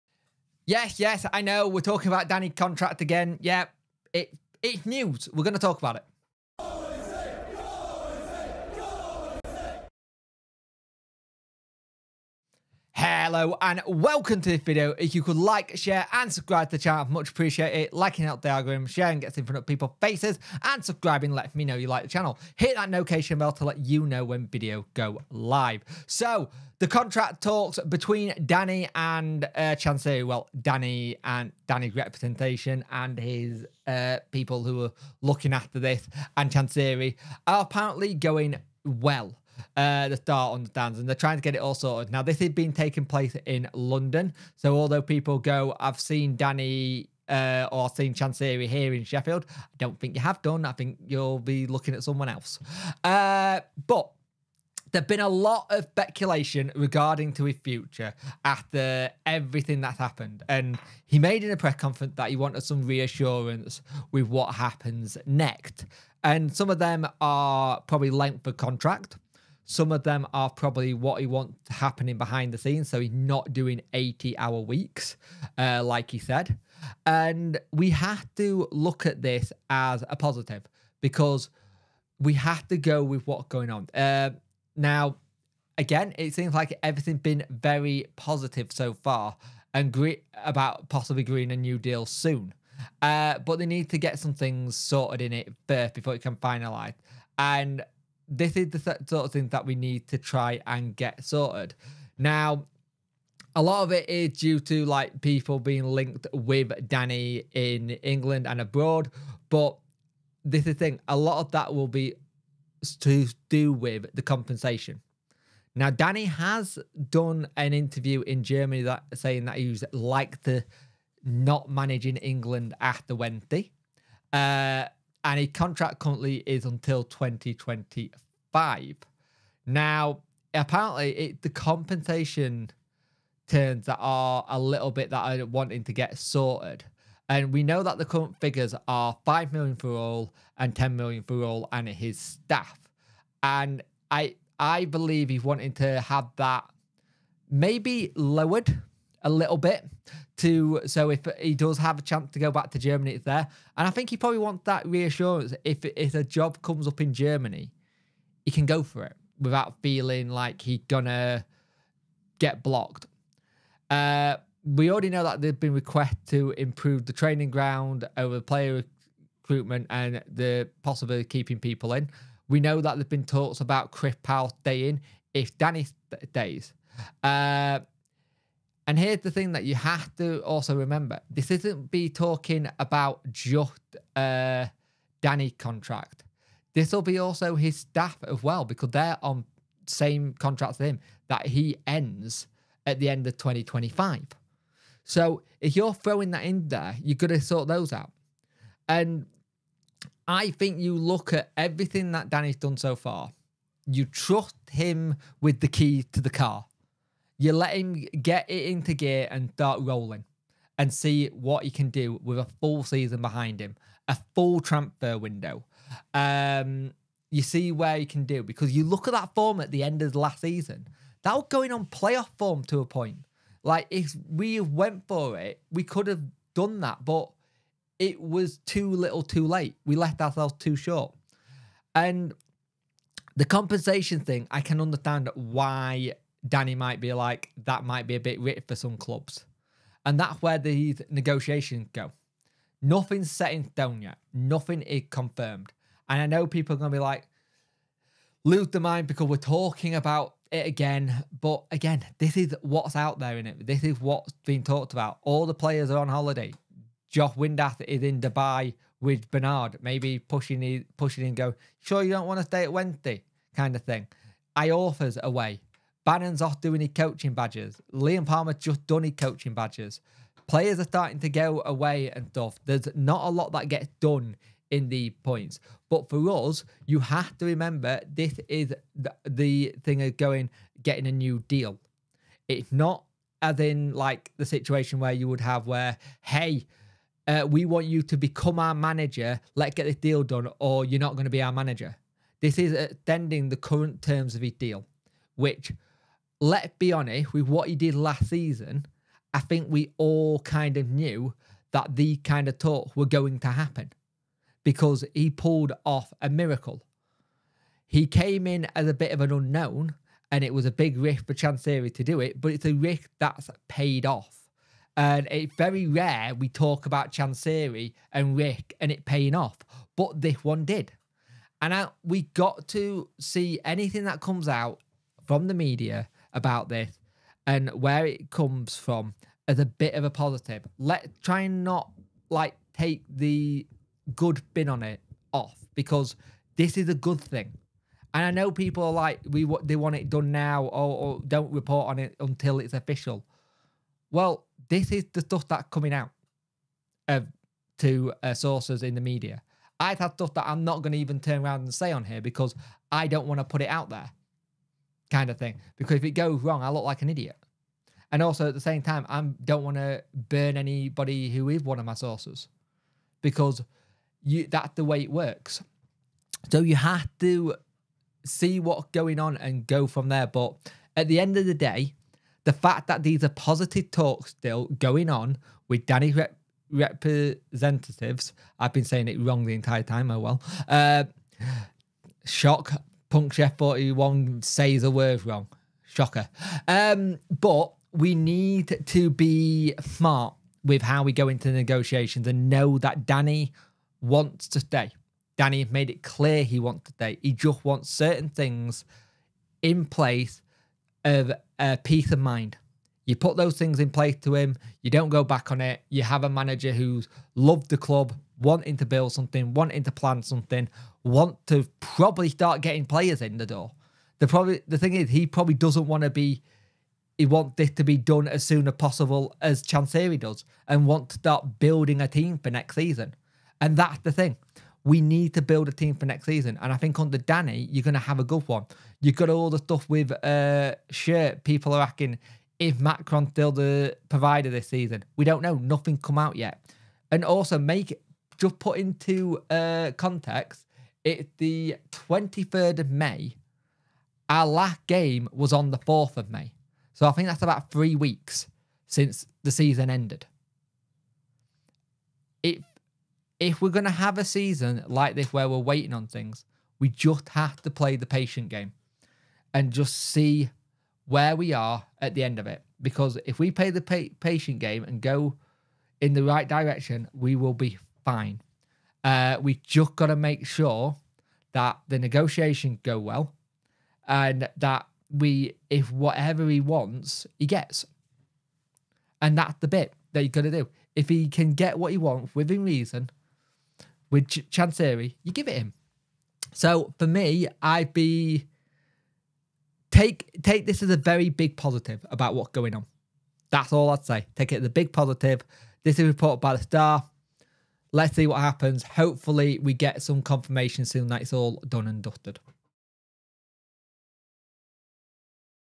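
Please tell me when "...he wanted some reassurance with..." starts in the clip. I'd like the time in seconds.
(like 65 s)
62 s.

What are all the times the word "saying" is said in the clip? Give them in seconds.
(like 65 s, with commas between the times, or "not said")
119 s, 378 s.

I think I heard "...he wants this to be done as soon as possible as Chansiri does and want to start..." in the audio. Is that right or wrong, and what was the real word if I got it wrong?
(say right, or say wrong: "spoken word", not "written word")
right.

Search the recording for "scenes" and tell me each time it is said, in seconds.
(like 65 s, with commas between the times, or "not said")
72 s.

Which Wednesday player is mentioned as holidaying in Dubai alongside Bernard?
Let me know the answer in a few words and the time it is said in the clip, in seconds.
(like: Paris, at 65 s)
Josh Windass, at 257 s.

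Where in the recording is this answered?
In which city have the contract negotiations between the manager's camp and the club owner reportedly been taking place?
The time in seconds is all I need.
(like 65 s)
43 s.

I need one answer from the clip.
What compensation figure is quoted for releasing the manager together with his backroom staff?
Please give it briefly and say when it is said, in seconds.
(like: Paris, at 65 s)
10 million, at 140 s.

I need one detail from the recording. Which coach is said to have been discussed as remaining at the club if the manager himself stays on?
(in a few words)
Chris Powell.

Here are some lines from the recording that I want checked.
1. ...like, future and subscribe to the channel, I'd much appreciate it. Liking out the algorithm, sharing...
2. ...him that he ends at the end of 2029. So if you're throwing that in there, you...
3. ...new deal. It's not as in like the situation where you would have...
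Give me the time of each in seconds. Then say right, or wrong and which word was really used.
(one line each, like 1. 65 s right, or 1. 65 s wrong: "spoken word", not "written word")
1. 15 s wrong: "share", not "future"
2. 190 s wrong: "2025", not "2029"
3. 281 s right.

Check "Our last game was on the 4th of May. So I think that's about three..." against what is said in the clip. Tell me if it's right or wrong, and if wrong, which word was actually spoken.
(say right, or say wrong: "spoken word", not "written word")
right.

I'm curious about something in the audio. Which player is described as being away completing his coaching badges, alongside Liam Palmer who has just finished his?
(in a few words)
Bannan.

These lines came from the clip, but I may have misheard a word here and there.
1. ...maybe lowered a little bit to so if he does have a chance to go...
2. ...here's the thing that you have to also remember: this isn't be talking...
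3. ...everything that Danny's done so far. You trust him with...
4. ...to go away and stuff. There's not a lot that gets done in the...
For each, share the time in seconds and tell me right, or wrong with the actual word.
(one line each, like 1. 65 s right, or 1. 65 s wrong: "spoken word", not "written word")
1. 147 s right
2. 178 s right
3. 201 s right
4. 271 s right.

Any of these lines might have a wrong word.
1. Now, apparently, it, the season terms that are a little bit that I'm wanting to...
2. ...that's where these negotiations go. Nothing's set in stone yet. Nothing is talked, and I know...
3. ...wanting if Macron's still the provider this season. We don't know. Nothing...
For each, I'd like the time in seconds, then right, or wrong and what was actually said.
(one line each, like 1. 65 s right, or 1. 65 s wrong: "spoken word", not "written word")
1. 129 s wrong: "compensation", not "season"
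2. 240 s wrong: "confirmed", not "talked"
3. 431 s wrong: "asking", not "wanting".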